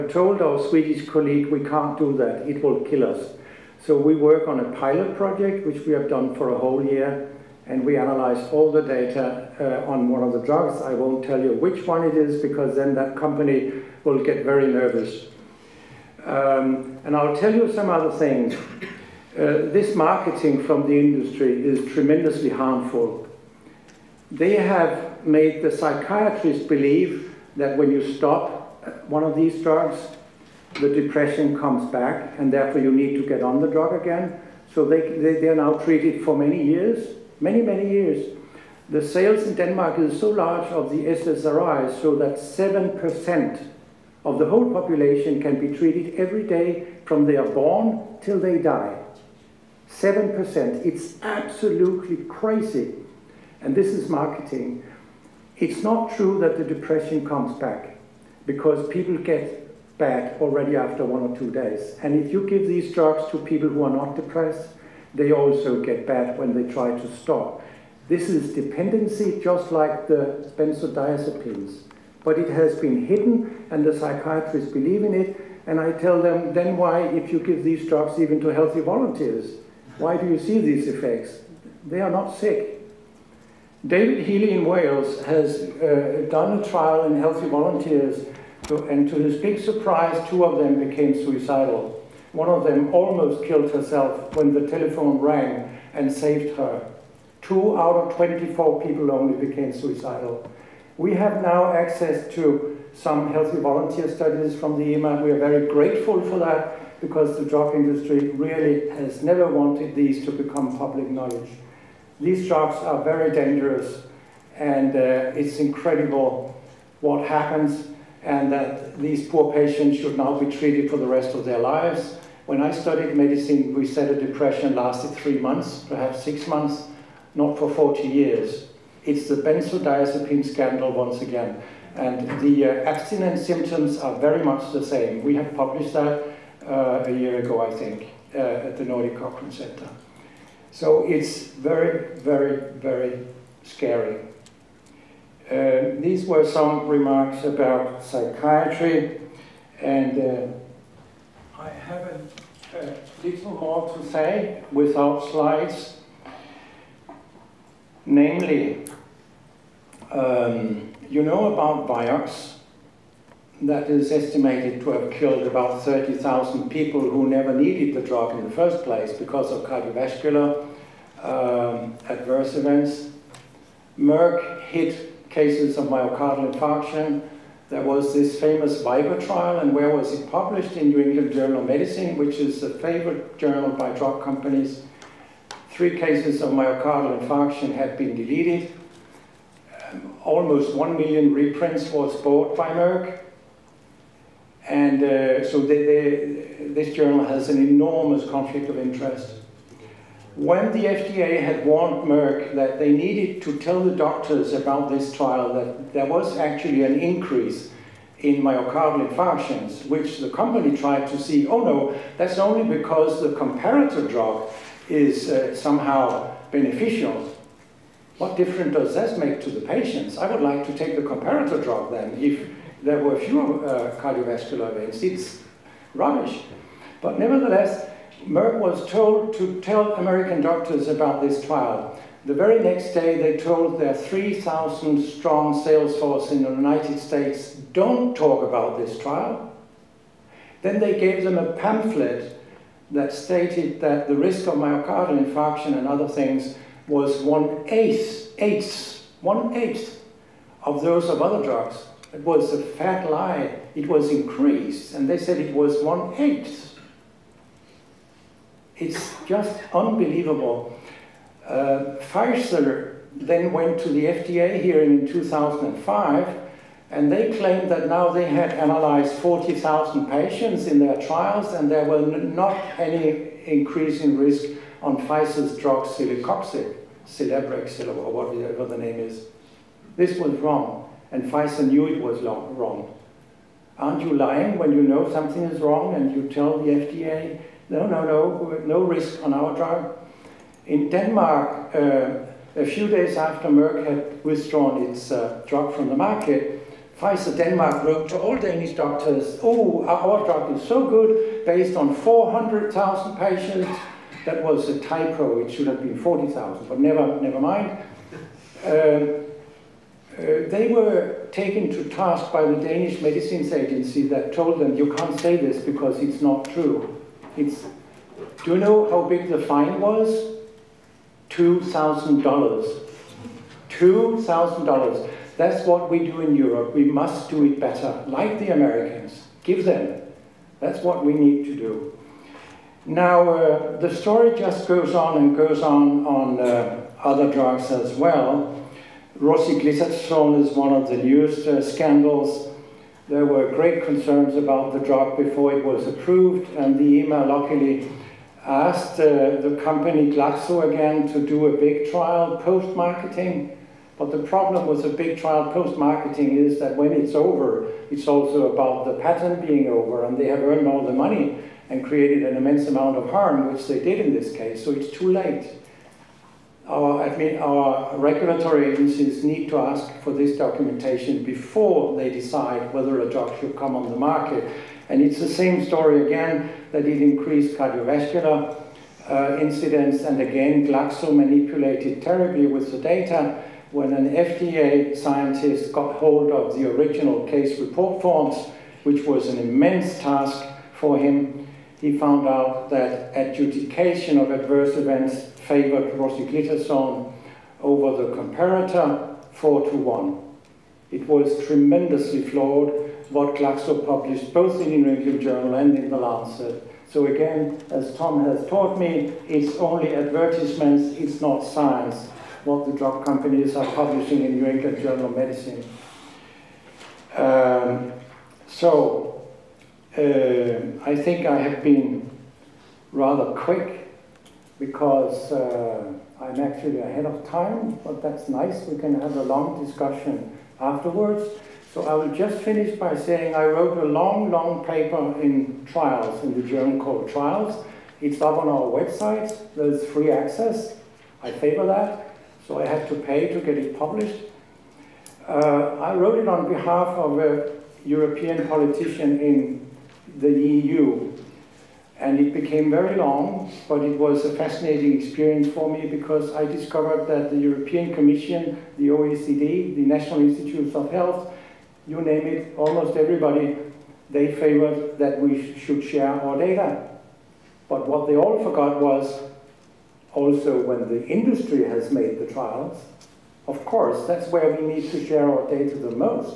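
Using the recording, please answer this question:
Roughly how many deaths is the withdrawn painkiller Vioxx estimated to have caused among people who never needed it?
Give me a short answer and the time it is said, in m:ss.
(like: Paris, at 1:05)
30,000, at 2:45.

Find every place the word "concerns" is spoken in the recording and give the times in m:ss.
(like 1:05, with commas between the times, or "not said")
5:43.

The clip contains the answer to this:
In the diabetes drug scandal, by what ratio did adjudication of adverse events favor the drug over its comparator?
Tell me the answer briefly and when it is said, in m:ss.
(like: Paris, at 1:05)
4 to 1, at 6:39.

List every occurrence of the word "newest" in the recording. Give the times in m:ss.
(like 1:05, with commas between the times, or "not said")
5:40.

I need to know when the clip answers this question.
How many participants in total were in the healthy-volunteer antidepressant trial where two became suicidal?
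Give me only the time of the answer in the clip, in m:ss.
1:38.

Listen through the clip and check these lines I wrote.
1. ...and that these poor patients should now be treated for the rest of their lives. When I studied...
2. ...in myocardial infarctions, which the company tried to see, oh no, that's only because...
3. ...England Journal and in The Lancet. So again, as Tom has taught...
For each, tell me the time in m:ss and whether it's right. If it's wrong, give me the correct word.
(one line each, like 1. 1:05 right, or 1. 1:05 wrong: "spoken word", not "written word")
1. 1:58 right
2. 3:28 right
3. 6:44 right.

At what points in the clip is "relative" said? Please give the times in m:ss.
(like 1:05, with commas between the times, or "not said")
not said.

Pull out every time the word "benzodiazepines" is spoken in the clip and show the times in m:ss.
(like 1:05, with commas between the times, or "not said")
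1:10, 2:09.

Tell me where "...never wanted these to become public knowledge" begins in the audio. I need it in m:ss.
1:49.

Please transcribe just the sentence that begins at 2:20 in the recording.
So it's very, very, very scary.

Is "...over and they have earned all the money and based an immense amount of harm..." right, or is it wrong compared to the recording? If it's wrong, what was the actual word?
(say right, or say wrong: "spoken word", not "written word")
wrong: "created", not "based".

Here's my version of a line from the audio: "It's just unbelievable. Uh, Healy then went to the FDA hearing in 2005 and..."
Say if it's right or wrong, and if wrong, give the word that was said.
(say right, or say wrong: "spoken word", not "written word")
wrong: "Pfizer", not "Healy".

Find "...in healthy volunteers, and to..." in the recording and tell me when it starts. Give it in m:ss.
1:27.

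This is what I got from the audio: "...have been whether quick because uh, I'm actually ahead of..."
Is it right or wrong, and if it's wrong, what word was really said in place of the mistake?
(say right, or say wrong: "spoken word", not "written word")
wrong: "rather", not "whether".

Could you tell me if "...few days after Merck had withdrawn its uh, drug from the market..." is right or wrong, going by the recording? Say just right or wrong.
right.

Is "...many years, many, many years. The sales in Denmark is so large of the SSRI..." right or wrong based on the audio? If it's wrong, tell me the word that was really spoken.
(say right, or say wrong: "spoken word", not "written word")
right.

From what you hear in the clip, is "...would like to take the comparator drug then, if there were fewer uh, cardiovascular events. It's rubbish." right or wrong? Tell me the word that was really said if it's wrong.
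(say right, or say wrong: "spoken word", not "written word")
right.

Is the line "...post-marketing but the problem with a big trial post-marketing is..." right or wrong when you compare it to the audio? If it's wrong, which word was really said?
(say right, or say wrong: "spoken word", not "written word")
right.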